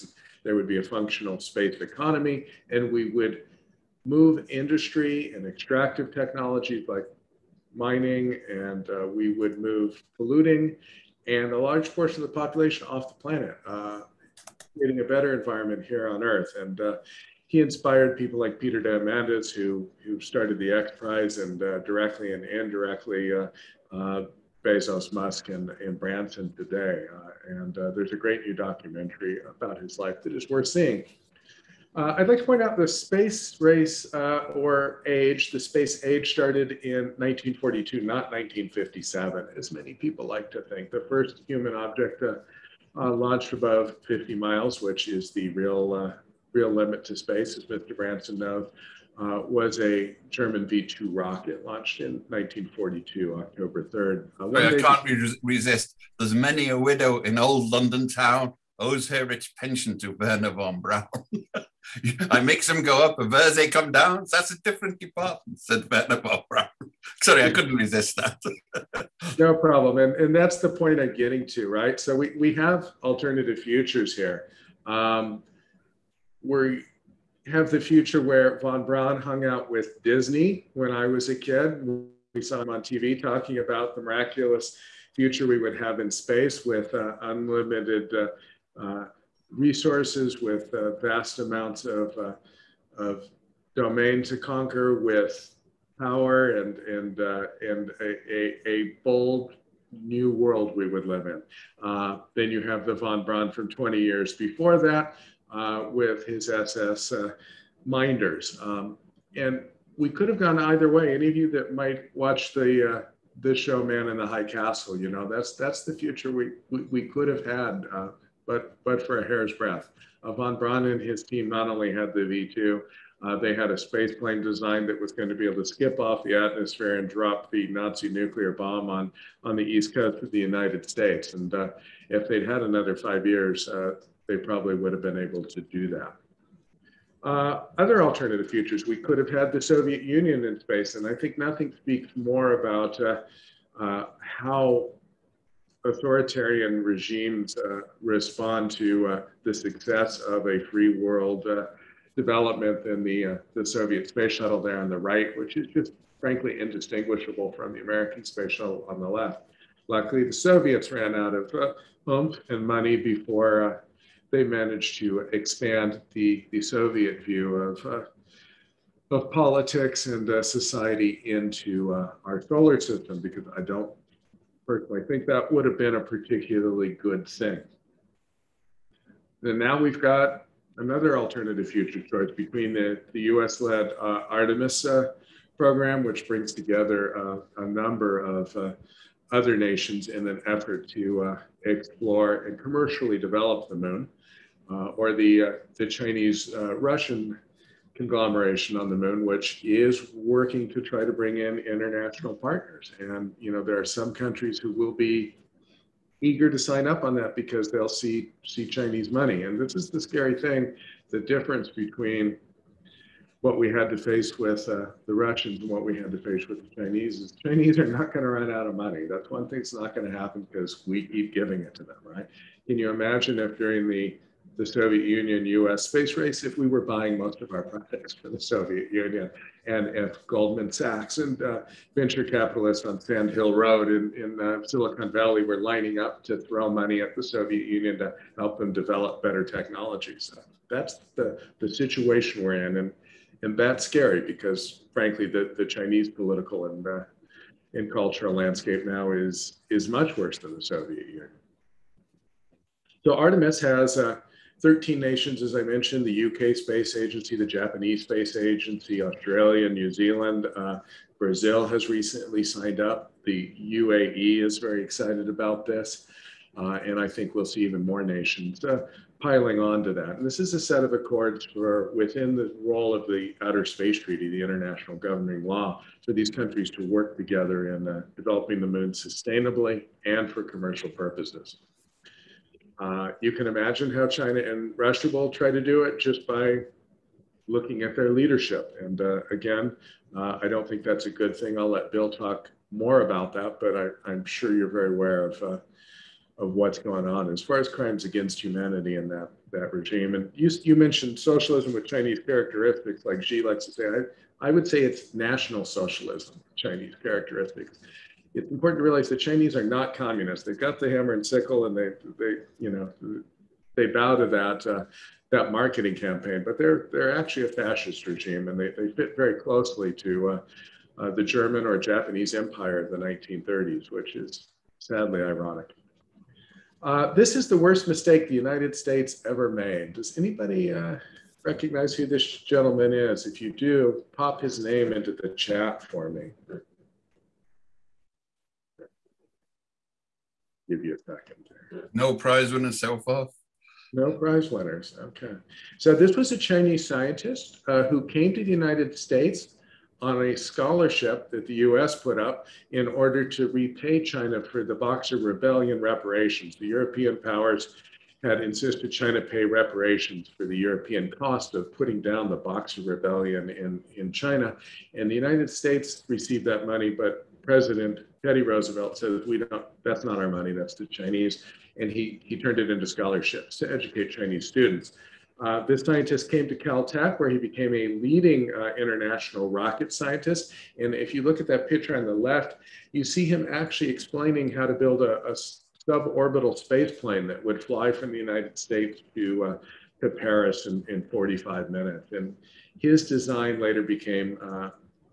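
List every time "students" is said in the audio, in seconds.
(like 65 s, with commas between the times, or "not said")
374 s.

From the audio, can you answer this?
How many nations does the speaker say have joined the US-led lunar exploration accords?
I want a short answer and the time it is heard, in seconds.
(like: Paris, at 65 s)
13, at 254 s.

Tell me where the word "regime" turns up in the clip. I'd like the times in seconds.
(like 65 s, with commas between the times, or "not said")
146 s, 299 s, 318 s.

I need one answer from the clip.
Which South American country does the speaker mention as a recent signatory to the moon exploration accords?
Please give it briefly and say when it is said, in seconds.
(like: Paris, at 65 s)
Brazil, at 261 s.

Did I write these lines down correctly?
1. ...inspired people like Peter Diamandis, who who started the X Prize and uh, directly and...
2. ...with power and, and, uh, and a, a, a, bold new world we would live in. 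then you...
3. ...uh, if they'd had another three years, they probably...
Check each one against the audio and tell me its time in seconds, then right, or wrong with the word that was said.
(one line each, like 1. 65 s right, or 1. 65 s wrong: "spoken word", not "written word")
1. 17 s right
2. 95 s right
3. 131 s wrong: "five", not "three".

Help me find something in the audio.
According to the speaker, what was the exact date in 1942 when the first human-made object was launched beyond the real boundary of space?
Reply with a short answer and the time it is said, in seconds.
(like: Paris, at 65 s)
October 3rd, at 53 s.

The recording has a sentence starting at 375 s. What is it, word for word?
Uh, this scientist came to Caltech where he became a leading uh, international rocket scientist.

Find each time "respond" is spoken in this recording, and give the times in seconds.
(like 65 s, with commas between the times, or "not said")
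148 s.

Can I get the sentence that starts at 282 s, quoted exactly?
Uh, you can imagine how China and Russia will try to do it just by looking at their leadership.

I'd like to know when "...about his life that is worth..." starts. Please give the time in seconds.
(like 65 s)
29 s.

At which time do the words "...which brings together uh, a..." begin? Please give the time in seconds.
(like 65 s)
186 s.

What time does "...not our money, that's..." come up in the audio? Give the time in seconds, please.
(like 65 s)
370 s.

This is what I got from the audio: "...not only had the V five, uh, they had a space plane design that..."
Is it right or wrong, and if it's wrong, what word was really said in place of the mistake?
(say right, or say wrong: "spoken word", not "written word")
wrong: "two", not "five".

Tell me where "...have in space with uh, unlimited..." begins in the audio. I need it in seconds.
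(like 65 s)
85 s.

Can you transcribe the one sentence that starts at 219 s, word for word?
That's one thing that's not going to happen because we keep giving it to them, right?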